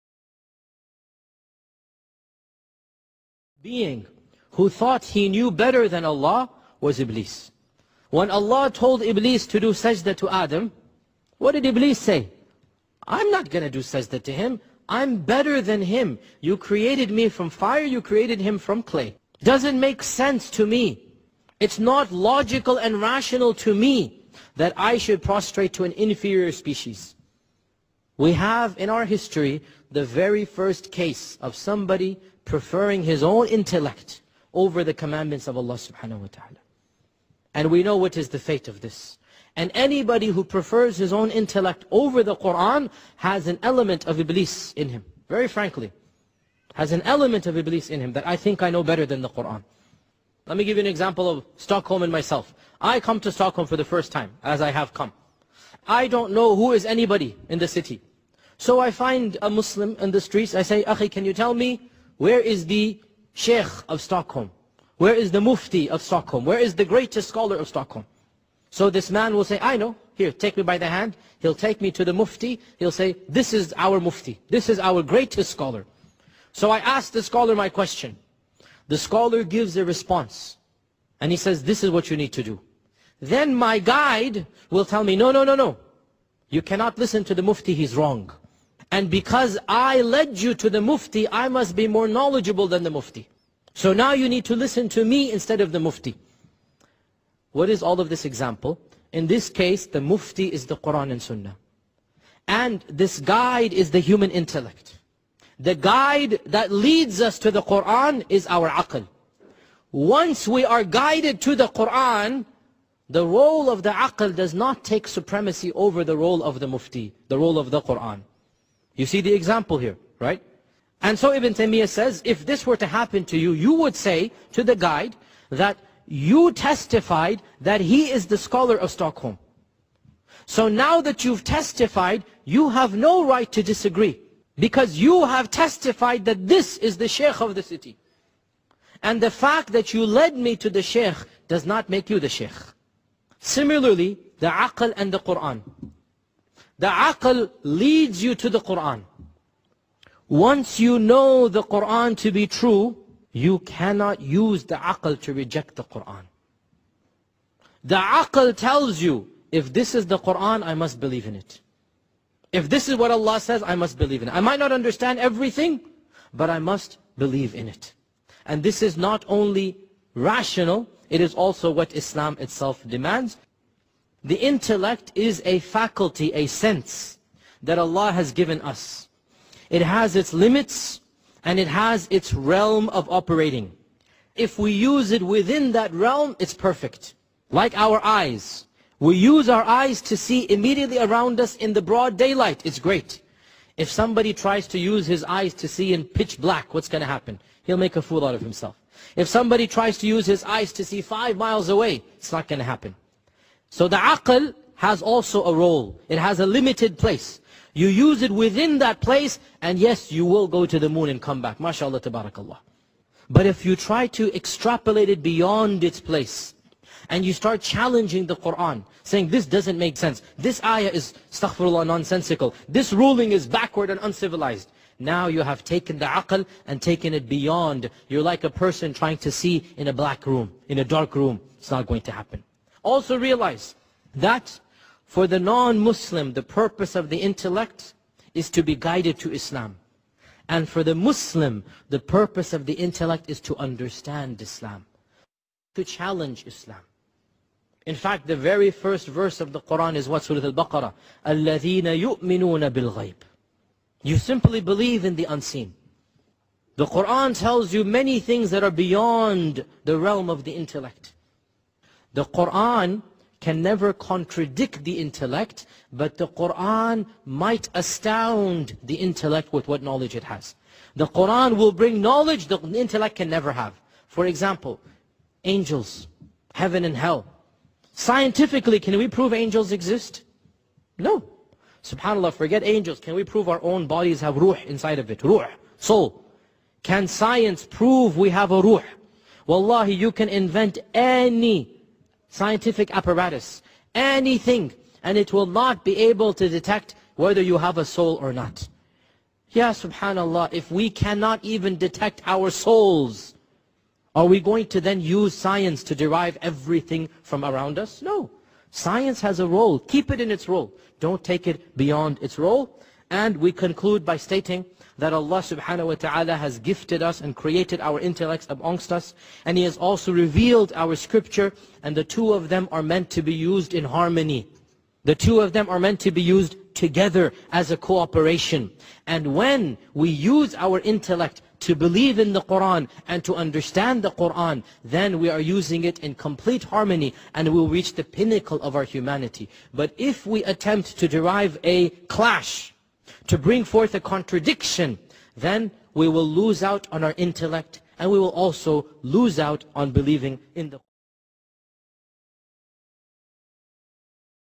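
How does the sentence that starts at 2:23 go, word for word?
Similarly, the aql and the Qur'an.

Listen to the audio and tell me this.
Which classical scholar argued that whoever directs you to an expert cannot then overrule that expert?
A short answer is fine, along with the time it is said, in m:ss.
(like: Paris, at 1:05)
Ibn Taymiyyah, at 2:01.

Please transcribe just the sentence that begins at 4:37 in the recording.
Scientifically, can we prove angels exist?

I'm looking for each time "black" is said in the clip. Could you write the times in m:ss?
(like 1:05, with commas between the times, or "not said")
3:16, 3:49.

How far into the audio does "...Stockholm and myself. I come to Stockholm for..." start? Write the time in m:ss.
0:51.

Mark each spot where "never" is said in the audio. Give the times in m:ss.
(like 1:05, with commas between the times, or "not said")
4:23, 4:33.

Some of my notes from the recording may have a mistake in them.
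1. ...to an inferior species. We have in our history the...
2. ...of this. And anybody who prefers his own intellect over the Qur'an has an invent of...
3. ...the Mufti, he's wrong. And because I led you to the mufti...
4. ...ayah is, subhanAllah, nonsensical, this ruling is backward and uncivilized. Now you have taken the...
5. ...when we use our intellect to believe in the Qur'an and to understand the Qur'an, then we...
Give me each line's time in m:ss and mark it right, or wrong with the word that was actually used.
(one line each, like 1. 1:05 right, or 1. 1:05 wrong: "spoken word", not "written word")
1. 0:25 right
2. 0:38 wrong: "element", not "invent"
3. 1:27 right
4. 3:40 wrong: "astaghfirullah", not "subhanAllah"
5. 5:29 right.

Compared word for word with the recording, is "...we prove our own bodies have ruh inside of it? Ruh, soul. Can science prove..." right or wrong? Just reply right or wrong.
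right.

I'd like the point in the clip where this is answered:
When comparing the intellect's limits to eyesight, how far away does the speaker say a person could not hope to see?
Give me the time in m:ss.
3:21.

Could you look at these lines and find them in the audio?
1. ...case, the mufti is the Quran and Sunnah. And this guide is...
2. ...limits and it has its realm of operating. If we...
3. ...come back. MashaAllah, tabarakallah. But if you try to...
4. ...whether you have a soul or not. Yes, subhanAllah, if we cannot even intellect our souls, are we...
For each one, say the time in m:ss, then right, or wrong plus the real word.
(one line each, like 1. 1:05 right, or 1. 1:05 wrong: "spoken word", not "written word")
1. 1:39 right
2. 3:00 right
3. 3:31 right
4. 4:57 wrong: "detect", not "intellect".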